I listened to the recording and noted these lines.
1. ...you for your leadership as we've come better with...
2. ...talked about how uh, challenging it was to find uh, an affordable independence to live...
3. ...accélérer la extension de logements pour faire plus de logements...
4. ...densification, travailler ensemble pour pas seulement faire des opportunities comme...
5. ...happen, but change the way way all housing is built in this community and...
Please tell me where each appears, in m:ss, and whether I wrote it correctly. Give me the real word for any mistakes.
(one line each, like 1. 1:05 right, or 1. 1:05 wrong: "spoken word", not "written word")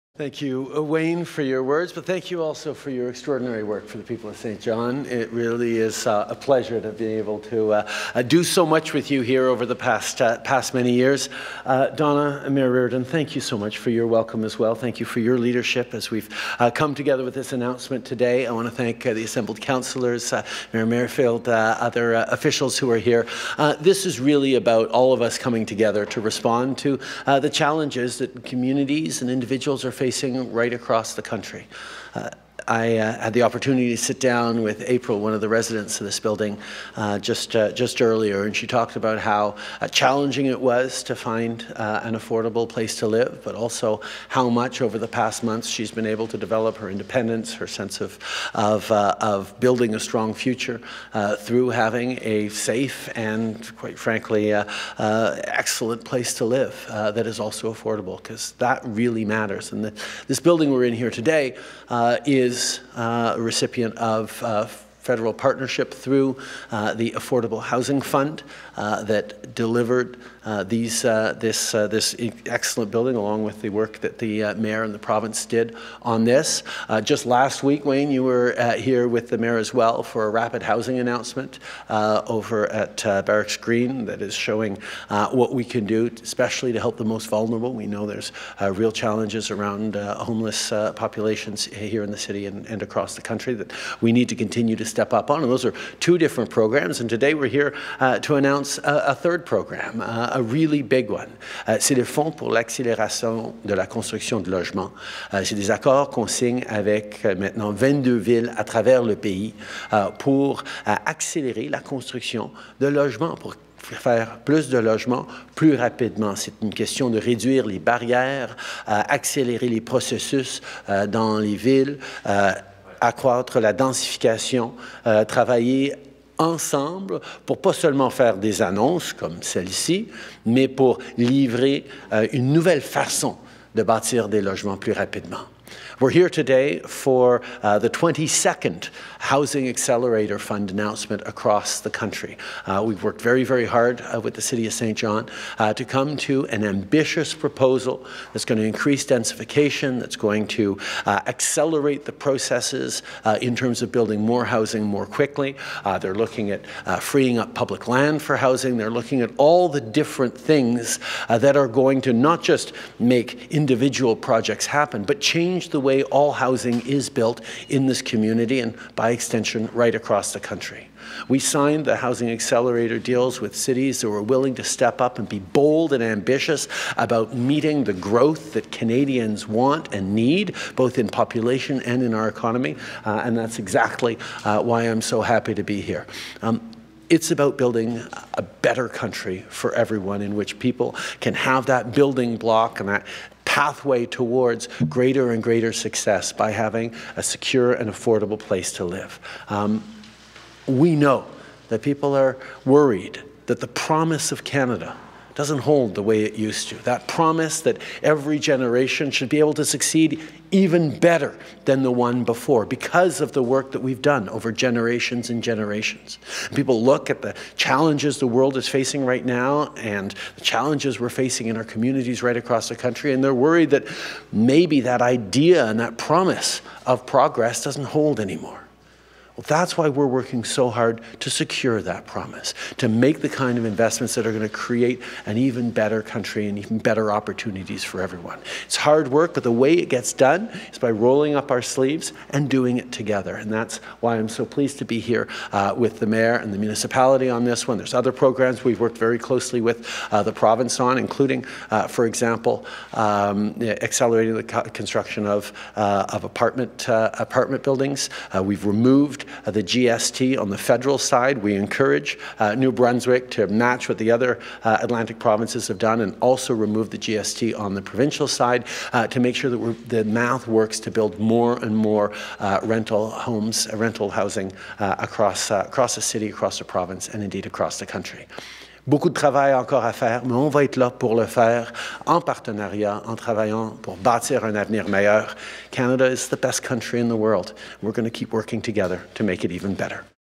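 1. 0:14 wrong: "together", not "better"
2. 0:38 wrong: "place", not "independence"
3. 1:50 wrong: "construction", not "extension"
4. 2:03 wrong: "annonces", not "opportunities"
5. 2:44 right.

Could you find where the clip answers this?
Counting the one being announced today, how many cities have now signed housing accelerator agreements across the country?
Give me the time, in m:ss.
1:47.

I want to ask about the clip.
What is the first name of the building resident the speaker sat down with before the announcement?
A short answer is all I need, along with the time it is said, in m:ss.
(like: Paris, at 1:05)
April, at 0:34.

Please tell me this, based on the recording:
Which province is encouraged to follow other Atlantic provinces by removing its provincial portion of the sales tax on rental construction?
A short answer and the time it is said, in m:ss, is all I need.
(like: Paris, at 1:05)
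New Brunswick, at 4:22.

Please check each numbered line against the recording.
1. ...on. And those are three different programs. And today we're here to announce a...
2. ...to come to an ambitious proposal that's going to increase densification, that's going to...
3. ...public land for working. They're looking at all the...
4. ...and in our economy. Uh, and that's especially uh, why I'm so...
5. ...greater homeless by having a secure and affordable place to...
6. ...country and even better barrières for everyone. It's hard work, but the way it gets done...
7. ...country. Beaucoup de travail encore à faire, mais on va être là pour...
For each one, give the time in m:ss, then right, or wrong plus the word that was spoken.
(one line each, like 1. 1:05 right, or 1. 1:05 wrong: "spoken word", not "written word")
1. 1:35 wrong: "two", not "three"
2. 2:25 right
3. 2:37 wrong: "housing", not "working"
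4. 3:01 wrong: "exactly", not "especially"
5. 3:15 wrong: "success", not "homeless"
6. 3:56 wrong: "opportunities", not "barrières"
7. 4:37 right.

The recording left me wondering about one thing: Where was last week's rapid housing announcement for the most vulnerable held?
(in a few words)
Barracks Green.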